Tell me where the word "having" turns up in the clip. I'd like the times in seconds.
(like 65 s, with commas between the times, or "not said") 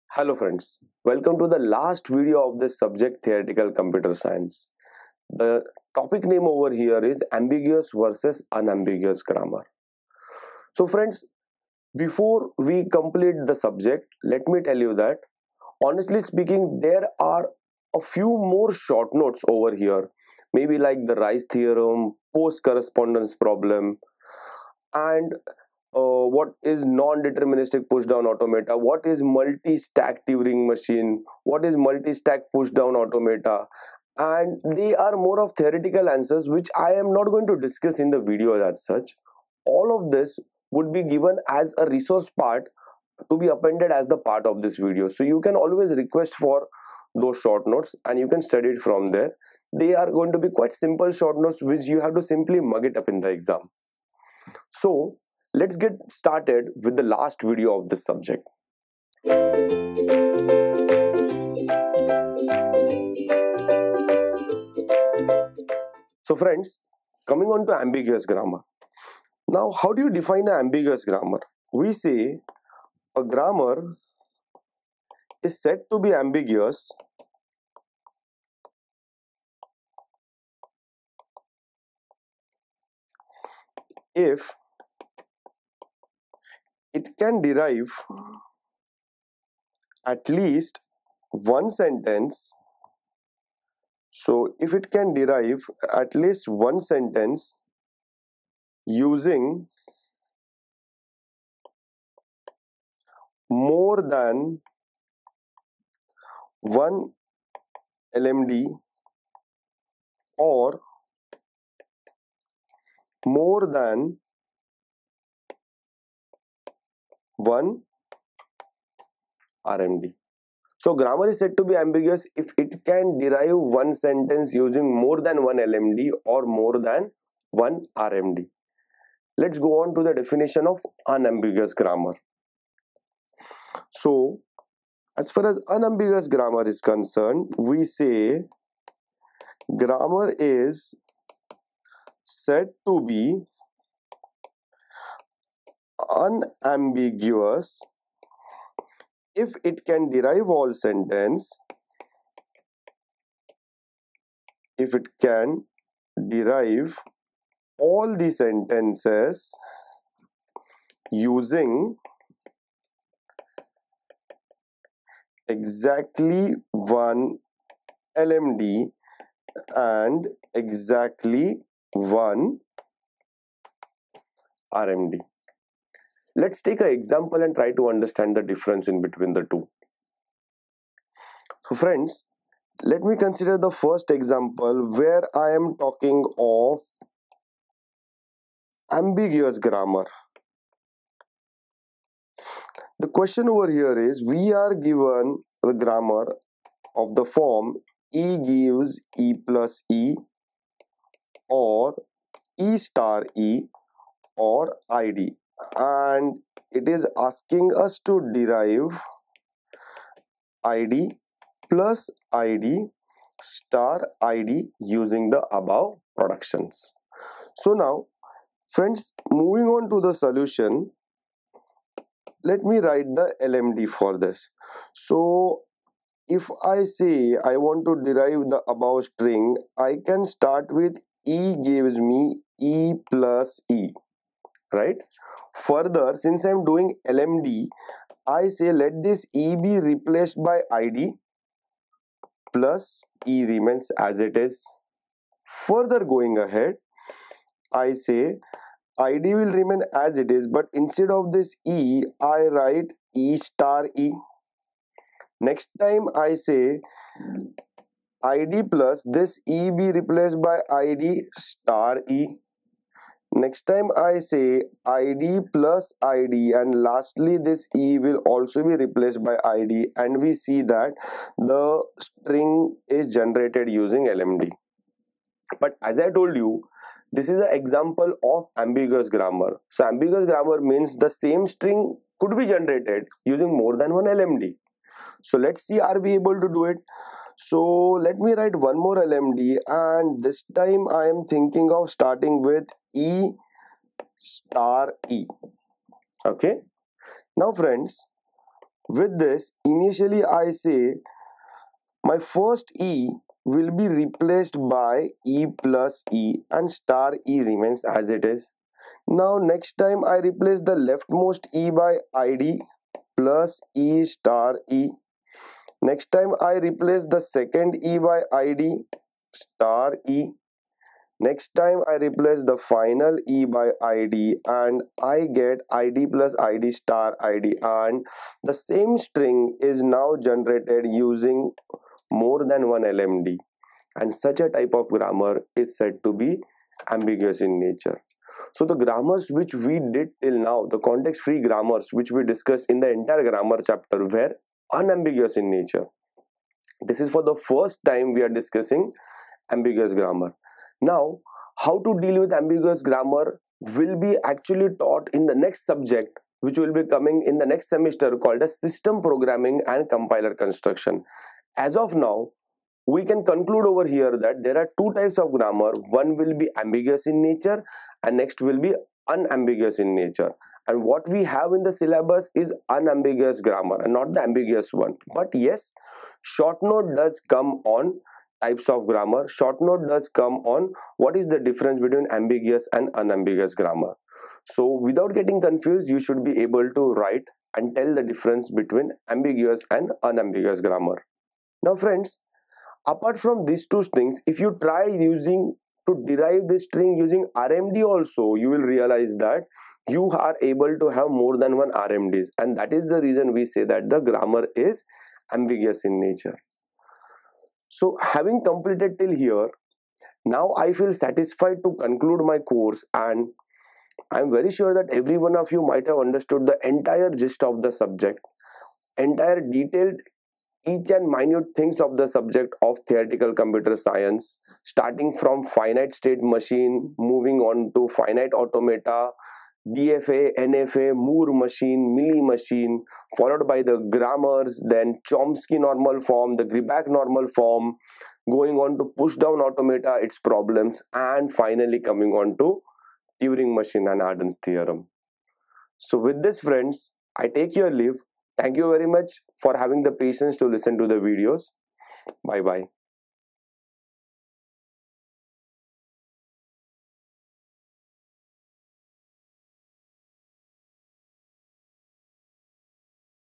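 408 s, 449 s.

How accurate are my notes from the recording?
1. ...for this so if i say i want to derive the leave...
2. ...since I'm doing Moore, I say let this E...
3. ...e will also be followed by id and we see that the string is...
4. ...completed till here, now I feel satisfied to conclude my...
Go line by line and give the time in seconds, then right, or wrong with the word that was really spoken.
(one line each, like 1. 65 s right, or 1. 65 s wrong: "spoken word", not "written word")
1. 223 s wrong: "above", not "leave"
2. 236 s wrong: "LMD", not "Moore"
3. 267 s wrong: "replaced", not "followed"
4. 408 s right.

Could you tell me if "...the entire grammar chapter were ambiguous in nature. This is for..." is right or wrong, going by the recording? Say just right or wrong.
wrong.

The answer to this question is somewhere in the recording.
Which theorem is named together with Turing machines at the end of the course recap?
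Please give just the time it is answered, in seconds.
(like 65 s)
444 s.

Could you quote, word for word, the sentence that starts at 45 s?
So you can always request for those short notes and you can study it from there.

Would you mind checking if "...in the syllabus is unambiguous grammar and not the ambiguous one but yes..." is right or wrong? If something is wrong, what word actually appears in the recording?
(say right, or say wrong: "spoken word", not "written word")
right.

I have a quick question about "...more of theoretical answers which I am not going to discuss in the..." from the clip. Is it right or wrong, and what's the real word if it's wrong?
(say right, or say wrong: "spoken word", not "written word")
right.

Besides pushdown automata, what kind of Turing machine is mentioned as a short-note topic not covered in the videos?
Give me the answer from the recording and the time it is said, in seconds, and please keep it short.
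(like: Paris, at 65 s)
Multi-stack Turing machine, at 29 s.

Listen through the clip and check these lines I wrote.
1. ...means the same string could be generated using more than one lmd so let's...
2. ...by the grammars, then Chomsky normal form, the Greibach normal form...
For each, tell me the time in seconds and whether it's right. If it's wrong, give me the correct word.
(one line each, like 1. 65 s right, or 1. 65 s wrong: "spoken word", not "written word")
1. 280 s right
2. 433 s right.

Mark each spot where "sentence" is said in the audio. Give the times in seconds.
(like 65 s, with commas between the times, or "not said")
91 s, 96 s, 123 s, 150 s, 158 s.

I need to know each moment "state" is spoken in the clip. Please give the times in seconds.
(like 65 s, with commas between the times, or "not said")
425 s.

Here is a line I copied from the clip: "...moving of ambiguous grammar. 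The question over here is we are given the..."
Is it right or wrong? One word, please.
wrong.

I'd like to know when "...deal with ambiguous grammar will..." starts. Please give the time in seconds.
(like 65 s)
351 s.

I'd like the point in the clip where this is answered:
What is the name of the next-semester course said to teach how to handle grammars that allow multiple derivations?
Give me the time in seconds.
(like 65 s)
358 s.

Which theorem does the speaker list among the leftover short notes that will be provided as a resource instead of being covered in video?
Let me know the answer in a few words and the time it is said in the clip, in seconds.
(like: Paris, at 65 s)
Rice theorem, at 21 s.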